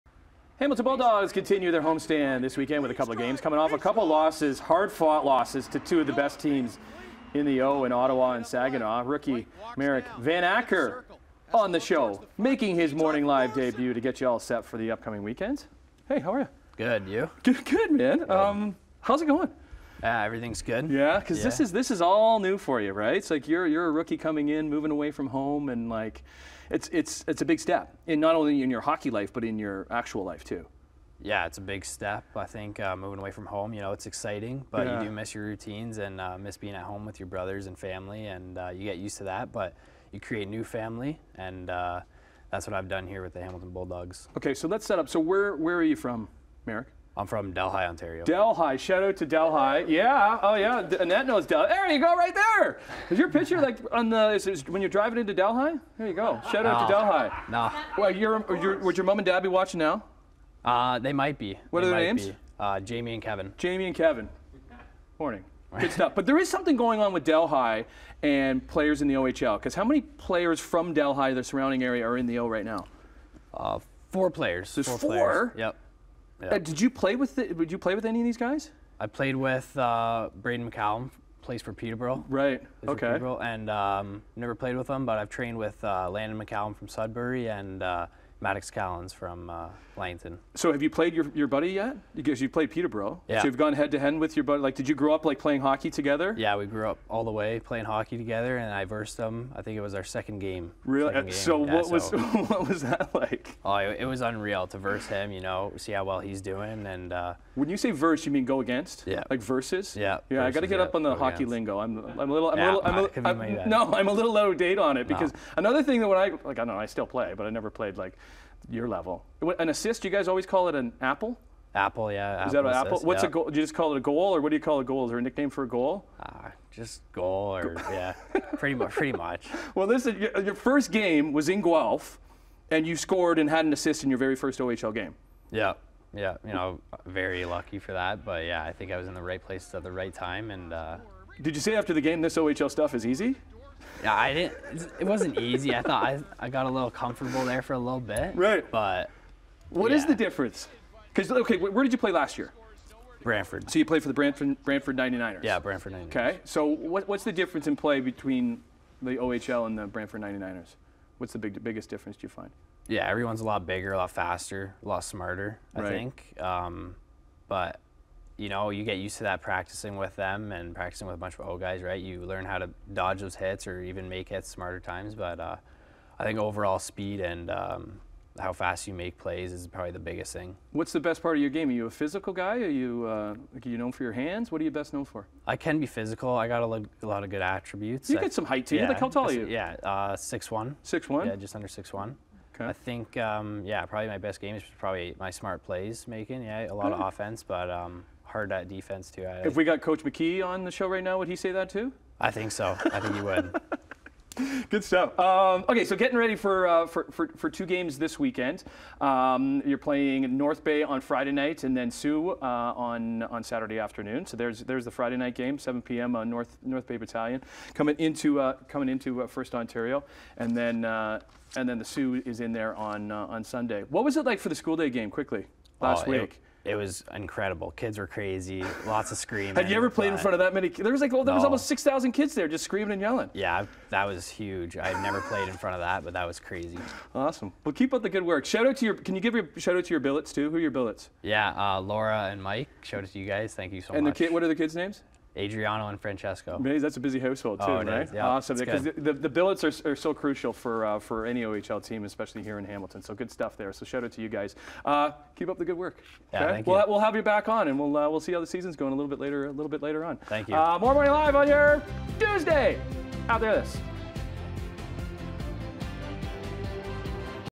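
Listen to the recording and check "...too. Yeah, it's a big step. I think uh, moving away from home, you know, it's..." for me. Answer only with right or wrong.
right.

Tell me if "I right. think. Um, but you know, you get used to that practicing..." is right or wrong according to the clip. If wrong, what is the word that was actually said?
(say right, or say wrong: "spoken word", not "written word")
right.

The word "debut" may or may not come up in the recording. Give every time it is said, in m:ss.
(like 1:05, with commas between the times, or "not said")
0:13.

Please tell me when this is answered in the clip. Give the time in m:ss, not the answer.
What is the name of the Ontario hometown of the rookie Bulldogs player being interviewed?
0:47.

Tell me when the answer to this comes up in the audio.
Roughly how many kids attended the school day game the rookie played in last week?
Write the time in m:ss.
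3:51.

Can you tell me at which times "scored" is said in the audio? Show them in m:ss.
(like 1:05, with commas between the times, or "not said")
2:12.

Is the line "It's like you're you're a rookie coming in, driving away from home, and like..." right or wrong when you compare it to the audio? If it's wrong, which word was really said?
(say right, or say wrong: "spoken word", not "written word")
wrong: "moving", not "driving".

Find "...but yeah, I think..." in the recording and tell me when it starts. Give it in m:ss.
2:18.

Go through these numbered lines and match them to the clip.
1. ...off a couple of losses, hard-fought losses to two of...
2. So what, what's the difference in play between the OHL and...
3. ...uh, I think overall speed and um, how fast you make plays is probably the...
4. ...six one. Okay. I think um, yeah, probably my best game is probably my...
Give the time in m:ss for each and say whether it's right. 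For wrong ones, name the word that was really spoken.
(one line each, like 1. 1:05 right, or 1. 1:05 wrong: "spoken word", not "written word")
1. 0:03 right
2. 2:36 right
3. 2:55 right
4. 3:11 right.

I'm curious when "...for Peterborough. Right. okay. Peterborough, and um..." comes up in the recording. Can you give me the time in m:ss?
1:21.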